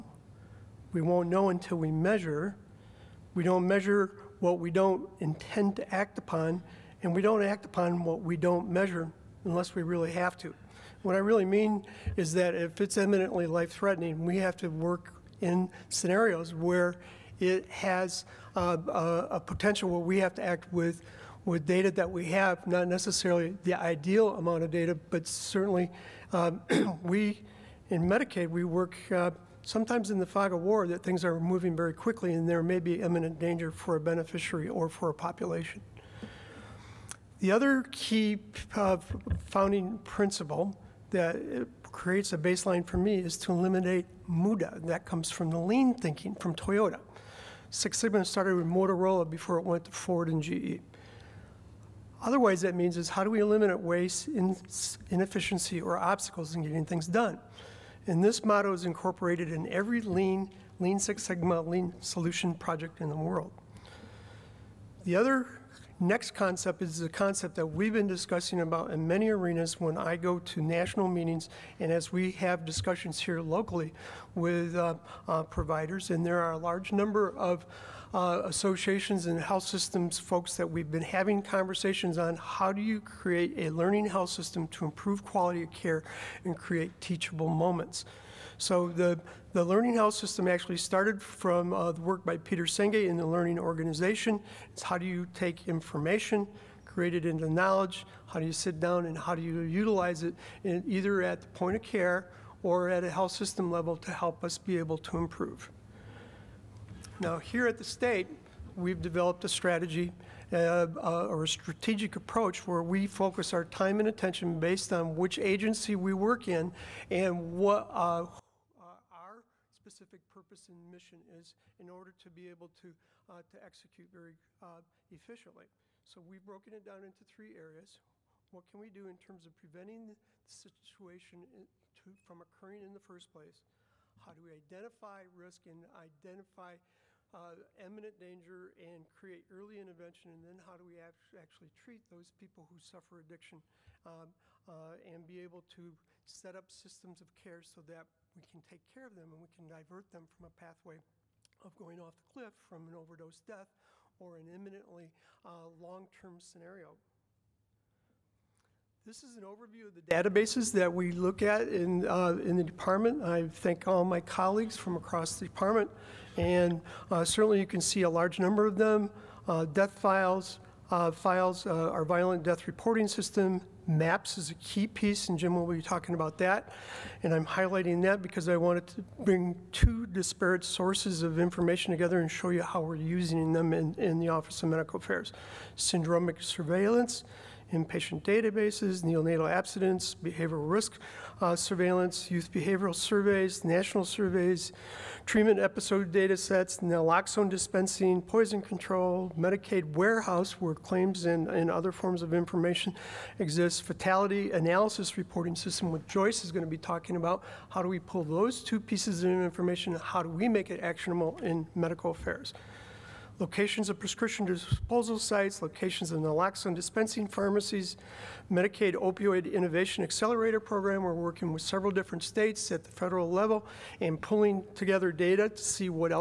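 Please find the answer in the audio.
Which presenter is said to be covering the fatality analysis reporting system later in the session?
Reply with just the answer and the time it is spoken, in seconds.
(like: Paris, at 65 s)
Joyce, at 206 s.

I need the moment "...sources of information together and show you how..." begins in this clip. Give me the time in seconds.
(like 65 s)
180 s.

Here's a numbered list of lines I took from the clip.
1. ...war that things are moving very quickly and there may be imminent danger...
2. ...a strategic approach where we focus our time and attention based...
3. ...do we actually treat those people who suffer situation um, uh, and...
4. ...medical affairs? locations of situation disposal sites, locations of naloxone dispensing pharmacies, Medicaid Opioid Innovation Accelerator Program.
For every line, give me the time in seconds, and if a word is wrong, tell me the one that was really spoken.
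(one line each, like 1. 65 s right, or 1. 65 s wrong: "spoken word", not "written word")
1. 30 s right
2. 111 s right
3. 140 s wrong: "addiction", not "situation"
4. 211 s wrong: "prescription", not "situation".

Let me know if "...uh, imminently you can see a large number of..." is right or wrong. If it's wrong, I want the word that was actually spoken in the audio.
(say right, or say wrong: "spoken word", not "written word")
wrong: "certainly", not "imminently".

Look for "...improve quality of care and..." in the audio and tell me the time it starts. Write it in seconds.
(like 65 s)
84 s.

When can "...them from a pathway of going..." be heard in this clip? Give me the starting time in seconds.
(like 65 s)
150 s.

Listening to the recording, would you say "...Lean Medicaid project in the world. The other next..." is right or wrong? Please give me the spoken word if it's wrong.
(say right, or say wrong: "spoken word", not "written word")
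wrong: "Solution", not "Medicaid".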